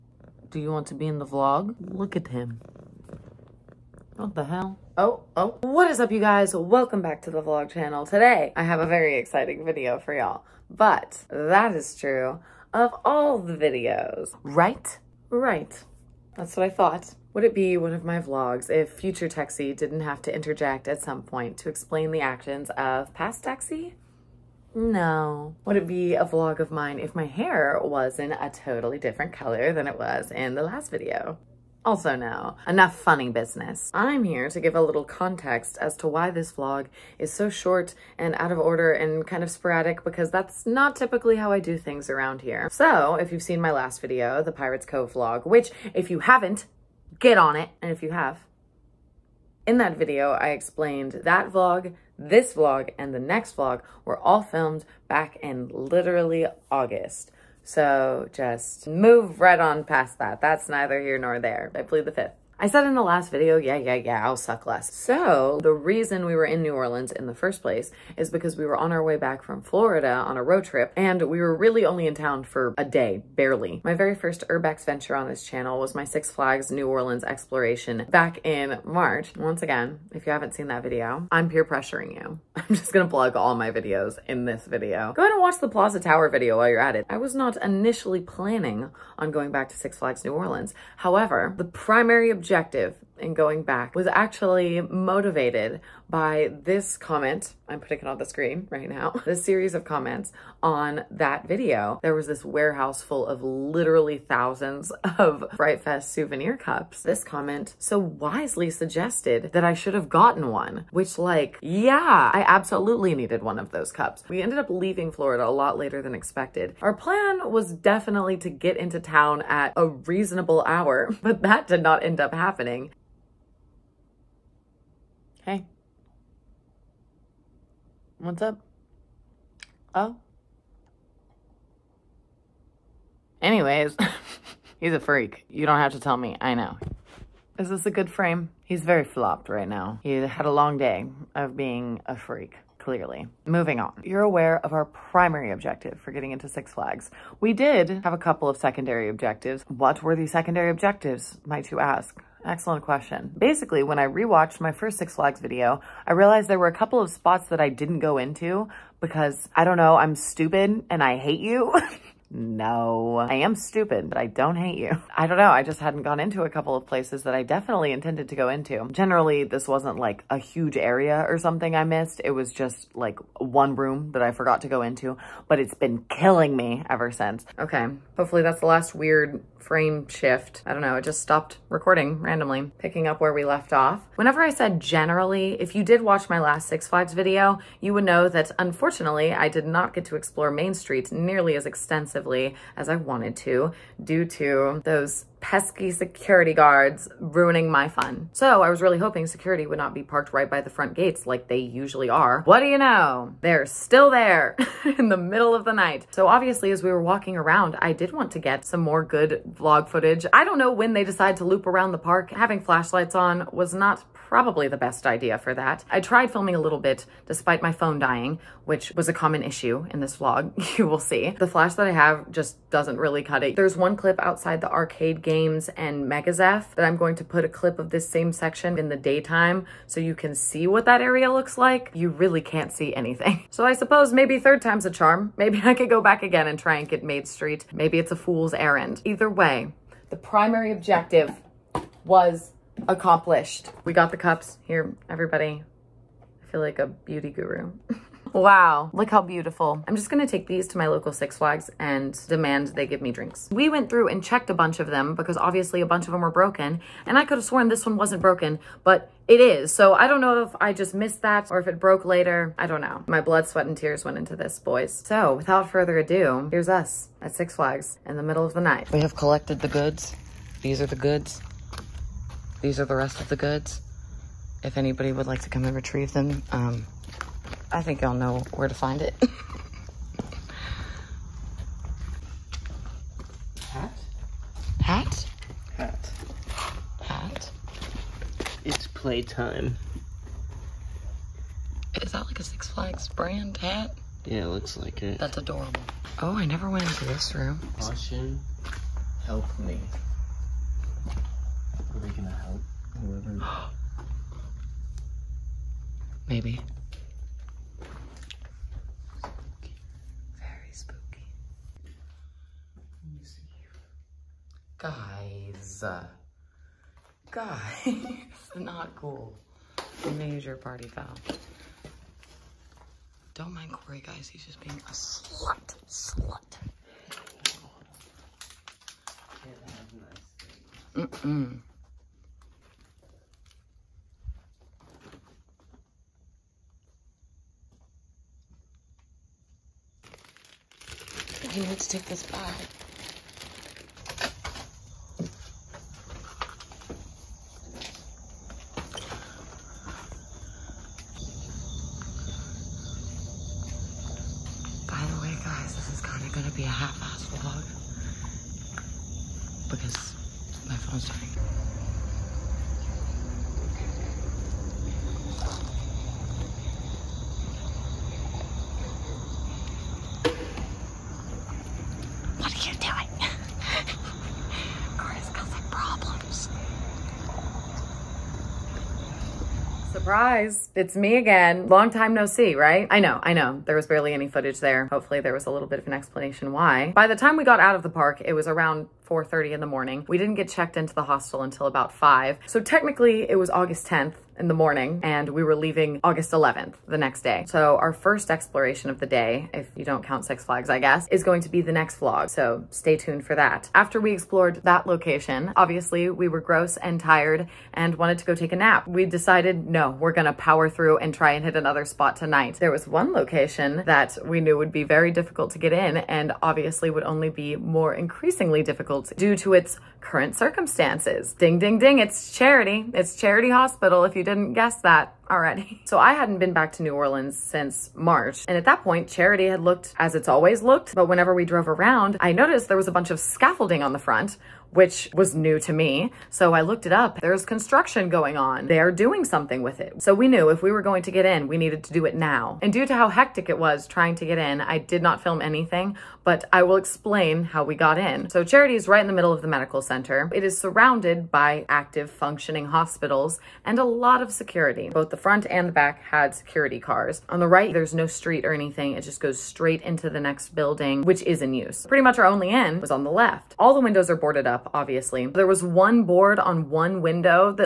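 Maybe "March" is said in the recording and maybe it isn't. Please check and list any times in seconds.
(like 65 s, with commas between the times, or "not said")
78 s, 427 s.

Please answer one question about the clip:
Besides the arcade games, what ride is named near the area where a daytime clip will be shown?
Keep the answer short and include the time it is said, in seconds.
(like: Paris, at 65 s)
Mega Zeph, at 226 s.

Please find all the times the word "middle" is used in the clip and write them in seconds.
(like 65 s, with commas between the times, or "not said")
205 s, 268 s, 449 s.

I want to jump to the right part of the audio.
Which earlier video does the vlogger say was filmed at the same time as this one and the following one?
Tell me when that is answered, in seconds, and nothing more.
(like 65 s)
44 s.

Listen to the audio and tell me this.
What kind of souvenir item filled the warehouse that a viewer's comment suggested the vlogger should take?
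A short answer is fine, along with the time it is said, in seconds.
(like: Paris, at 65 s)
Fright Fest souvenir cups, at 105 s.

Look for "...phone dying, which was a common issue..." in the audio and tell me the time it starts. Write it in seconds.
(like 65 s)
217 s.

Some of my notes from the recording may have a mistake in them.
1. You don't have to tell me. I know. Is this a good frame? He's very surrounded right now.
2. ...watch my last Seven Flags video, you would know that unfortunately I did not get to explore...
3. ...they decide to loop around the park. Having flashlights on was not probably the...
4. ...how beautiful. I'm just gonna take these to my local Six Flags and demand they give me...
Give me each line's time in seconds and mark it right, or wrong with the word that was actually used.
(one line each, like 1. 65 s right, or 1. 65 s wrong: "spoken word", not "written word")
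1. 135 s wrong: "flopped", not "surrounded"
2. 186 s wrong: "Six", not "Seven"
3. 210 s right
4. 249 s right.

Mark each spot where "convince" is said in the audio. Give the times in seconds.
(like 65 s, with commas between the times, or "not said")
not said.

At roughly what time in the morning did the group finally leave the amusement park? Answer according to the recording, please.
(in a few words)
4:30.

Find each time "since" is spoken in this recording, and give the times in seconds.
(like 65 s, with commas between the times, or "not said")
177 s, 427 s.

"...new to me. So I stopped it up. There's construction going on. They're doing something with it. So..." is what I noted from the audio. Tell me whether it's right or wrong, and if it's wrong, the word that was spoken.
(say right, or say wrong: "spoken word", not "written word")
wrong: "looked", not "stopped".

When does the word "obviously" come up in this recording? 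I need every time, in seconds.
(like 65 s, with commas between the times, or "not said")
206 s, 255 s, 405 s, 416 s, 464 s.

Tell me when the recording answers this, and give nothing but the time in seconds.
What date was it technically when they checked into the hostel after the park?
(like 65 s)
393 s.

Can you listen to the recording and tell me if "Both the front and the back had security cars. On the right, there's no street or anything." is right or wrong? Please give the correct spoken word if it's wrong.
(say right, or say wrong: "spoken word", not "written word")
right.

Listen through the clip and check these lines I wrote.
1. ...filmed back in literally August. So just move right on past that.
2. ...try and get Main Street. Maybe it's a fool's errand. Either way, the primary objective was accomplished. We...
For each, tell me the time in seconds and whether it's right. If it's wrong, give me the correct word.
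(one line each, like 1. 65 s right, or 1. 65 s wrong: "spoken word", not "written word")
1. 54 s right
2. 236 s right.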